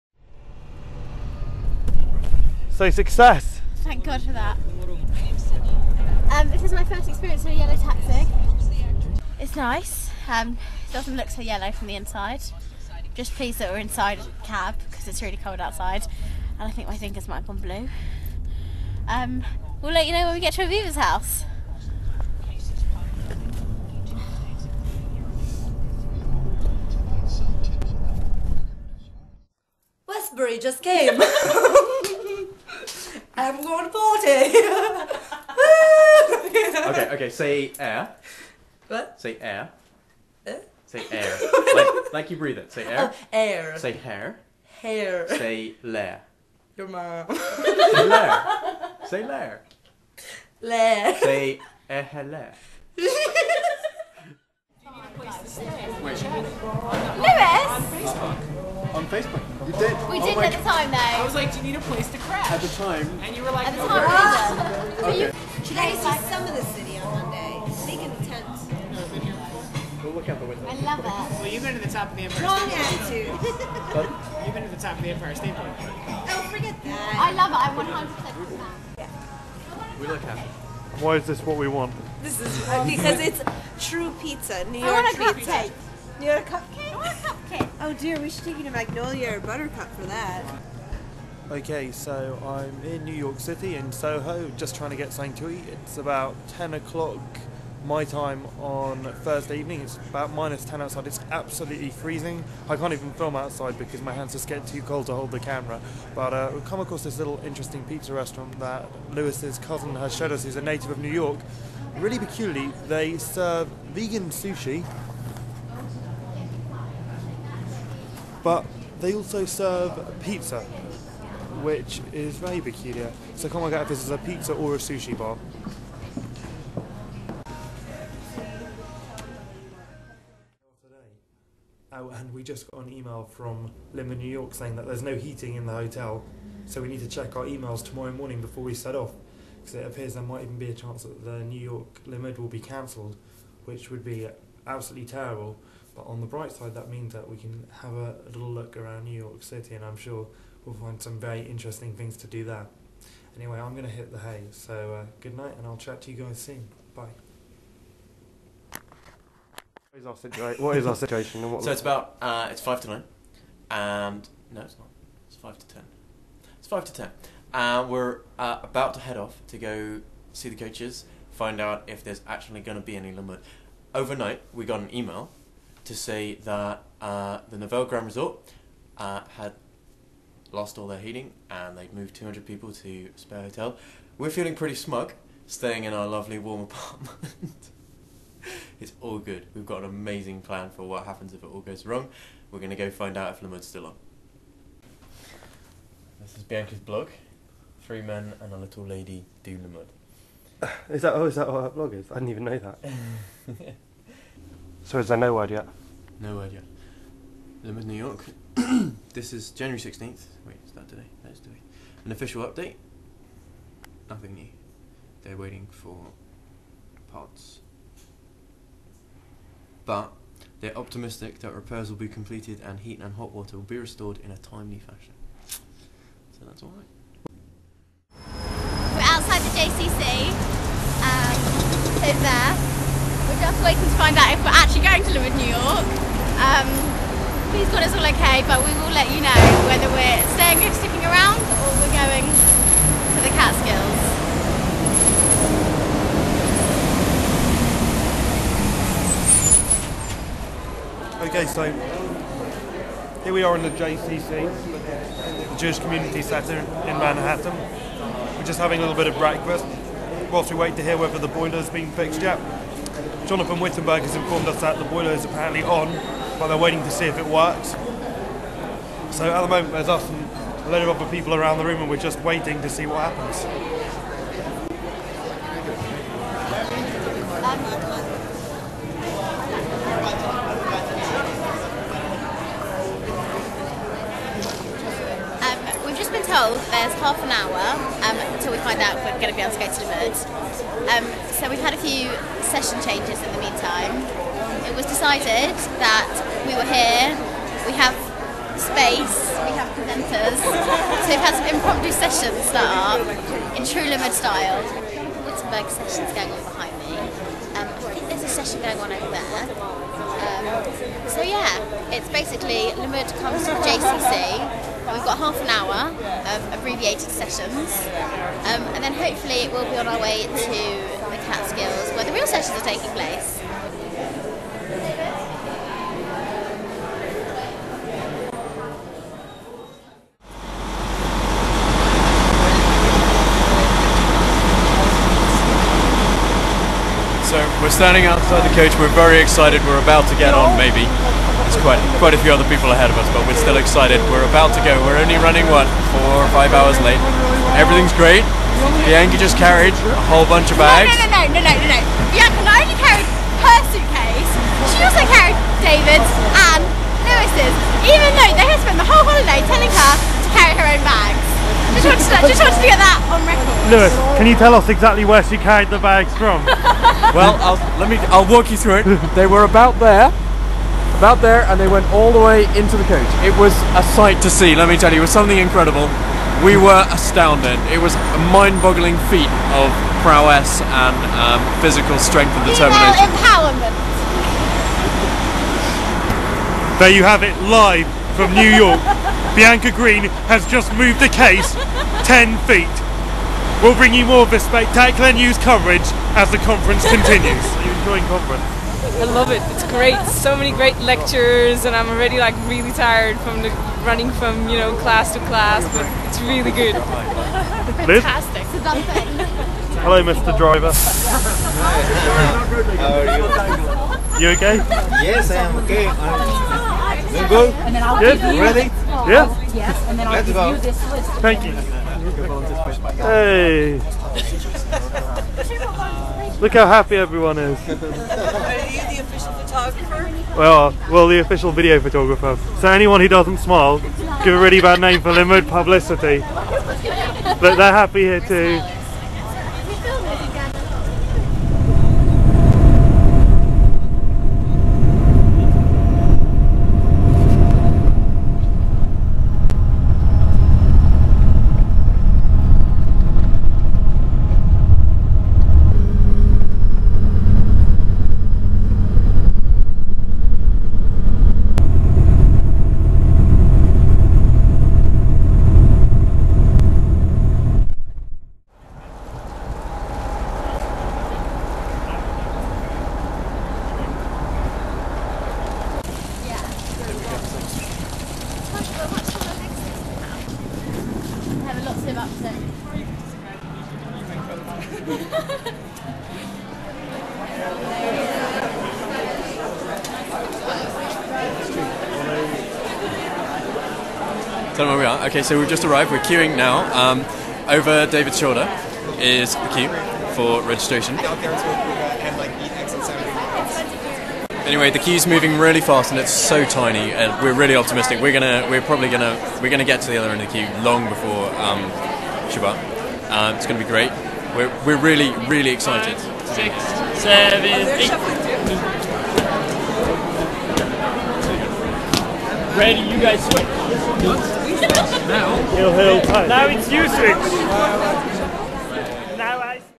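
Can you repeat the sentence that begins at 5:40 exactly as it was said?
There's quite, quite a few other people ahead of us, but we're still excited.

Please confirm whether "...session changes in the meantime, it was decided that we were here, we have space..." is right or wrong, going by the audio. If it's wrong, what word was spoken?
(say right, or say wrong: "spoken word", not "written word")
right.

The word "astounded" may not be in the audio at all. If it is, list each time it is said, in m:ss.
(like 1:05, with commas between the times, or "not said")
6:16.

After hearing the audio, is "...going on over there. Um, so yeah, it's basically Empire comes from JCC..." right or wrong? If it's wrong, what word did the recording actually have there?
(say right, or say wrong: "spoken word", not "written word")
wrong: "Limmud", not "Empire".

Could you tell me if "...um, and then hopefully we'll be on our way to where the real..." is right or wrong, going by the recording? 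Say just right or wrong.
right.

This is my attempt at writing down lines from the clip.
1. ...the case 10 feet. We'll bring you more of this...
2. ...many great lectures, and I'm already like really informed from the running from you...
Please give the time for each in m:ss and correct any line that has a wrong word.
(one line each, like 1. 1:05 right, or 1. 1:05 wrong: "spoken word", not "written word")
1. 6:30 right
2. 6:40 wrong: "tired", not "informed".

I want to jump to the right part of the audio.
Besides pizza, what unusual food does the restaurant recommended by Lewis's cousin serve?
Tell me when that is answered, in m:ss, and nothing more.
1:53.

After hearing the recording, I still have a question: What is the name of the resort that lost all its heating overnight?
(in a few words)
Nevele Grand Resort.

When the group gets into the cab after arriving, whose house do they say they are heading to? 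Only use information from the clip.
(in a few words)
Aviva's house.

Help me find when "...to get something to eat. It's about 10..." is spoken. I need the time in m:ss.
1:34.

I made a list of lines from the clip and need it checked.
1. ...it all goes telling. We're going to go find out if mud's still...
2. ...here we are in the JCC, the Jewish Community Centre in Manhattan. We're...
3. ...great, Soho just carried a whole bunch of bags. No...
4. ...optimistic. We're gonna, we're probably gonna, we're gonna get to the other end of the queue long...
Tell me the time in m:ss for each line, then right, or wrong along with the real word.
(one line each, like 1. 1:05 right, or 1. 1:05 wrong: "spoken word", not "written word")
1. 3:11 wrong: "wrong", not "telling"
2. 4:13 right
3. 5:47 wrong: "Bianca", not "Soho"
4. 8:27 right.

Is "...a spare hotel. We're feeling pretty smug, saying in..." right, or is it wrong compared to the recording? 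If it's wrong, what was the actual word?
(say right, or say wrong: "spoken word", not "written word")
wrong: "staying", not "saying".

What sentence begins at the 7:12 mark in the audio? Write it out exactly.
So anyone who doesn't smile, give a really bad name for Limmud publicity.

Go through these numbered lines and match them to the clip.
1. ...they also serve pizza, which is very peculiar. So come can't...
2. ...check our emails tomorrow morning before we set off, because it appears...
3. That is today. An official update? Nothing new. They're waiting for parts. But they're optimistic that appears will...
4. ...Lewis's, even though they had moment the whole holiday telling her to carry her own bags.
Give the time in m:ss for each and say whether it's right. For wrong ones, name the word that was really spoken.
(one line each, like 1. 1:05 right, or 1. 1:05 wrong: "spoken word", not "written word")
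1. 1:58 right
2. 2:17 right
3. 3:31 wrong: "repairs", not "appears"
4. 5:57 wrong: "spent", not "moment".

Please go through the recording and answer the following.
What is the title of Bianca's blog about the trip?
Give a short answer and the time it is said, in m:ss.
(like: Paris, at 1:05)
Three men and a little lady do Limmud, at 3:17.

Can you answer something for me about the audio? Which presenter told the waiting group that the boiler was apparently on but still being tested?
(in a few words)
Jonathan Wittenberg.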